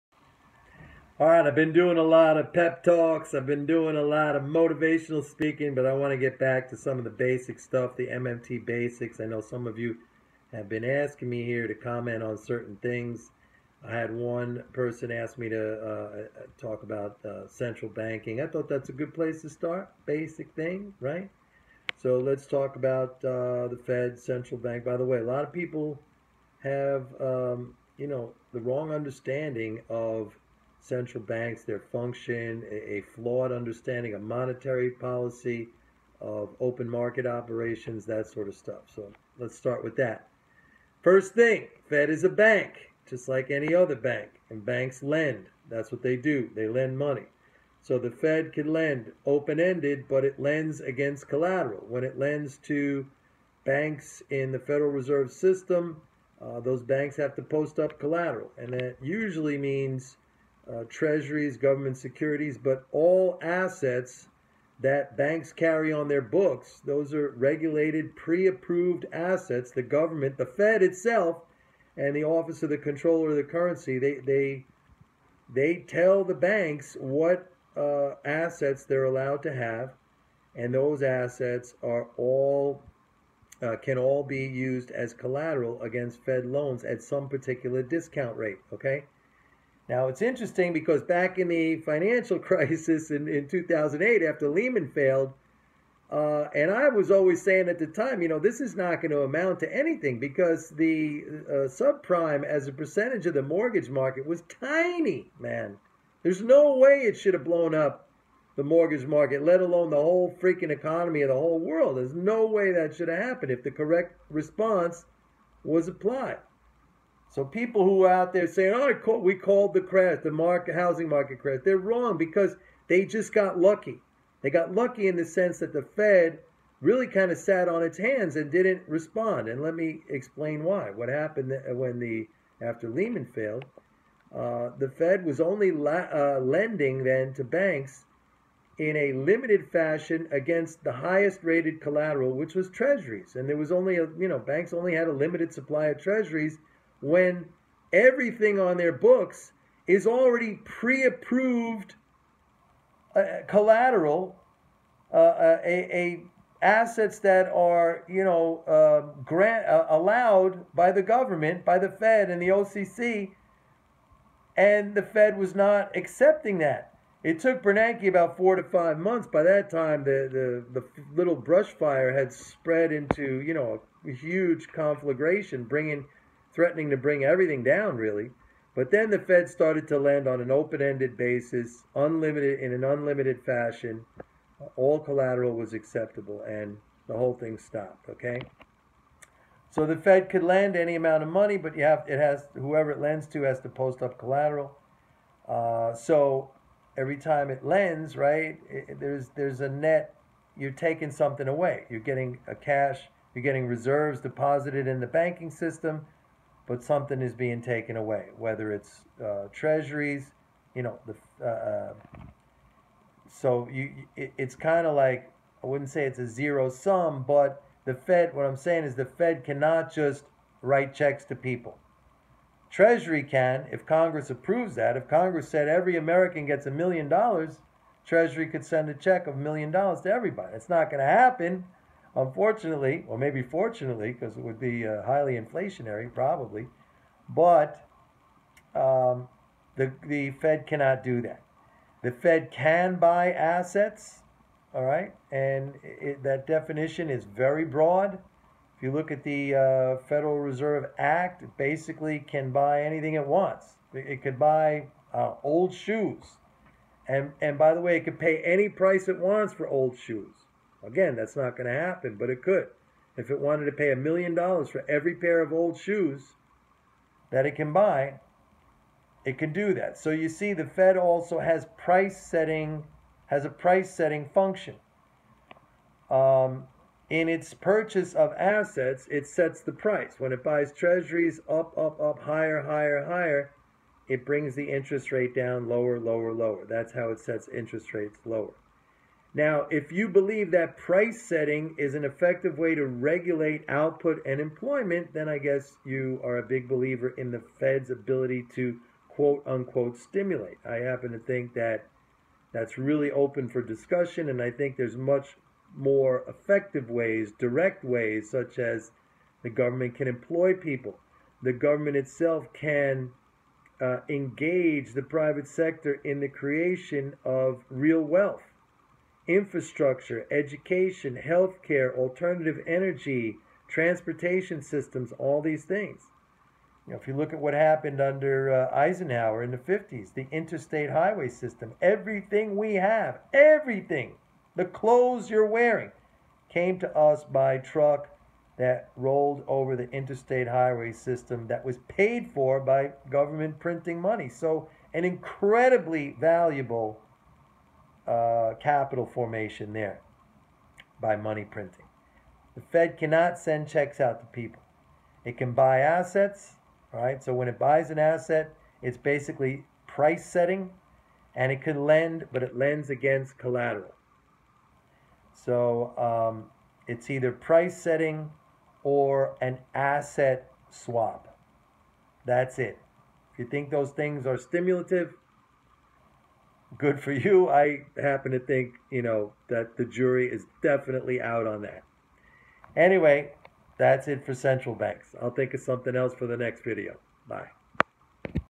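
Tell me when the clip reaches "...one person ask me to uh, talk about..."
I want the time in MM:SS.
00:14.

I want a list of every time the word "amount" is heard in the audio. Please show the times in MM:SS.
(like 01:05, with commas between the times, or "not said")
01:39, 03:10.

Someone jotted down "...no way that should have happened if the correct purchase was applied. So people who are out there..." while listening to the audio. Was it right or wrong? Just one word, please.
wrong.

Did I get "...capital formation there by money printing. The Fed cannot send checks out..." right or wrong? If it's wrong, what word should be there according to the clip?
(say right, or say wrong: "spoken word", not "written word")
right.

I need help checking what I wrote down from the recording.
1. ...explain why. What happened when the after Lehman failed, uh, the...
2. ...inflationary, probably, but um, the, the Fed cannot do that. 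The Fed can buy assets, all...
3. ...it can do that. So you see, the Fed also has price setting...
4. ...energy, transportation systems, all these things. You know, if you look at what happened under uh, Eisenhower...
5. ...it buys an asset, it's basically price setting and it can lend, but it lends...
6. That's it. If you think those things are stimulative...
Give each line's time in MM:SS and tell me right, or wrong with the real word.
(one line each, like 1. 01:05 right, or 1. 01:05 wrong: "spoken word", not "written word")
1. 02:10 right
2. 03:55 right
3. 04:29 right
4. 05:22 right
5. 05:57 right
6. 06:12 right.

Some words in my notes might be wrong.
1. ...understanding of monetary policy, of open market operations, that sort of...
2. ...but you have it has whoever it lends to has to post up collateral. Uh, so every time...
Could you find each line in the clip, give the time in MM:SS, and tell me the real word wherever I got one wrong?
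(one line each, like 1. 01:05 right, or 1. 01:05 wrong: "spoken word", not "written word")
1. 00:33 right
2. 03:11 right.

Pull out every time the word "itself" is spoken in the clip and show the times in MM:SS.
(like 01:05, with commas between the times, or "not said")
01:10, 05:11.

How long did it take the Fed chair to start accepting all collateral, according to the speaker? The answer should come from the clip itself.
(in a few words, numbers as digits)
4 to 5 months.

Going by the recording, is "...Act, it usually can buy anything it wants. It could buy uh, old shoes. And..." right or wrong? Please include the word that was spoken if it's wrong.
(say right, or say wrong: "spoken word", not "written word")
wrong: "basically", not "usually".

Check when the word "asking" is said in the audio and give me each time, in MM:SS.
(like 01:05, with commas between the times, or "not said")
00:10.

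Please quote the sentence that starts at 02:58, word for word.
But then the Fed started to lend on an open ended basis, unlimited in an unlimited fashion.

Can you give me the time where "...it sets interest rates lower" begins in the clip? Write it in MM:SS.
04:47.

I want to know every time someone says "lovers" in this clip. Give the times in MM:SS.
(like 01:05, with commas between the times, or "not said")
not said.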